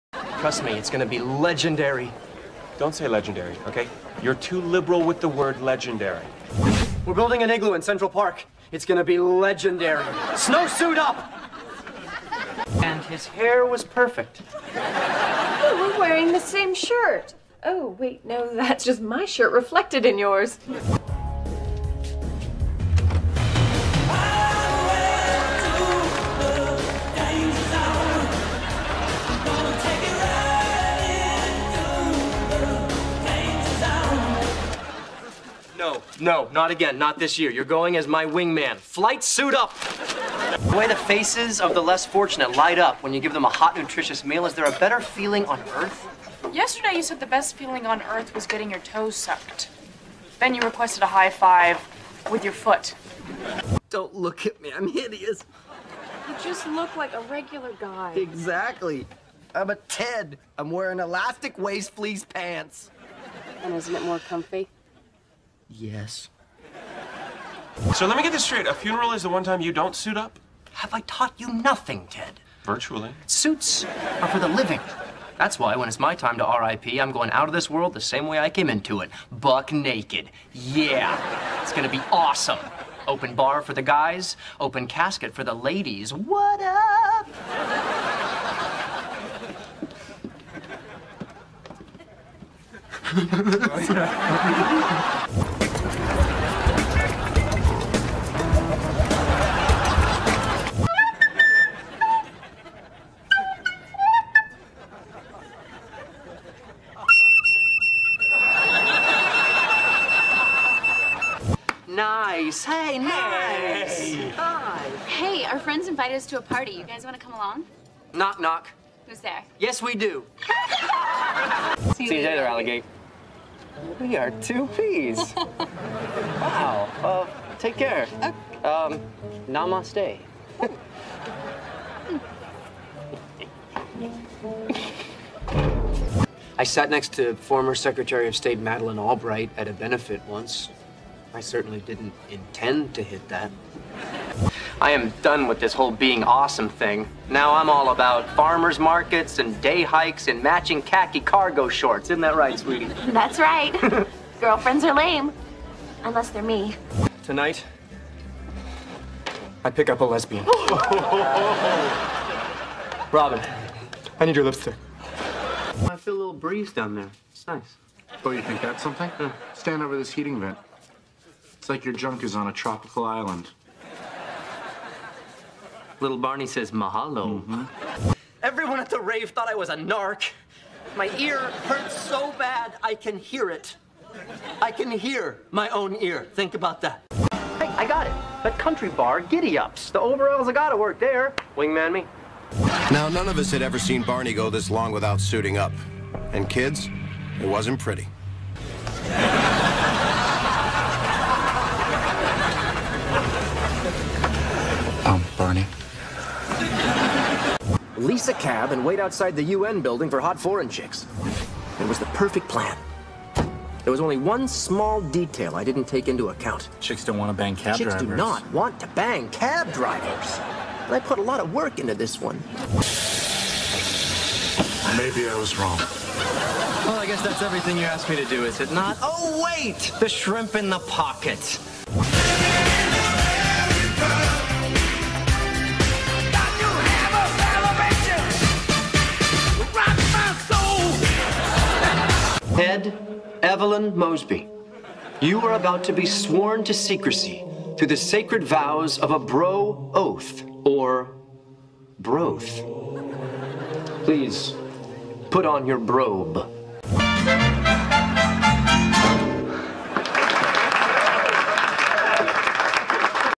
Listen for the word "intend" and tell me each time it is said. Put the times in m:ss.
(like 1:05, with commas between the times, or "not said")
2:22.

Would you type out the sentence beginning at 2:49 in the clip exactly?
Stand over this heating vent like your junk is on a tropical island.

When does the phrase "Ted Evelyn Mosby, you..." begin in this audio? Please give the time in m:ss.
4:02.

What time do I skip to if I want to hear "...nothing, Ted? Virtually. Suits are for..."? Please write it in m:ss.
1:11.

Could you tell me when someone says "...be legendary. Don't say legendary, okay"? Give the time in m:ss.
0:01.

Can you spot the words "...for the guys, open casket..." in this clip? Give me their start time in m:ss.
1:23.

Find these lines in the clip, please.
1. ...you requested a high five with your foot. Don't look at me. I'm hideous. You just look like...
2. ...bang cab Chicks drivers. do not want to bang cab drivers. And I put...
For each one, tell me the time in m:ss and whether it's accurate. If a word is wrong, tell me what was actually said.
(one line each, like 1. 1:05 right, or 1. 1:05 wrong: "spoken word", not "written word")
1. 0:50 right
2. 3:37 right.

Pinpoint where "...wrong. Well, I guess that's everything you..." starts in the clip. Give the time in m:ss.
3:45.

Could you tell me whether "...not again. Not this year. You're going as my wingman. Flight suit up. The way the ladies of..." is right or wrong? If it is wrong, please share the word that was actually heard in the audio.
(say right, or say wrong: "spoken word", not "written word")
wrong: "faces", not "ladies".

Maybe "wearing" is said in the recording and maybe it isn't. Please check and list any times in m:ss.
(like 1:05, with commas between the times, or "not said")
0:15, 1:00.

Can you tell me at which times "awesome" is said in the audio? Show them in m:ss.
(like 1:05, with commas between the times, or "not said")
1:22, 2:26.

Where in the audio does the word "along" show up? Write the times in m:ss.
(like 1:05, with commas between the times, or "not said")
1:57.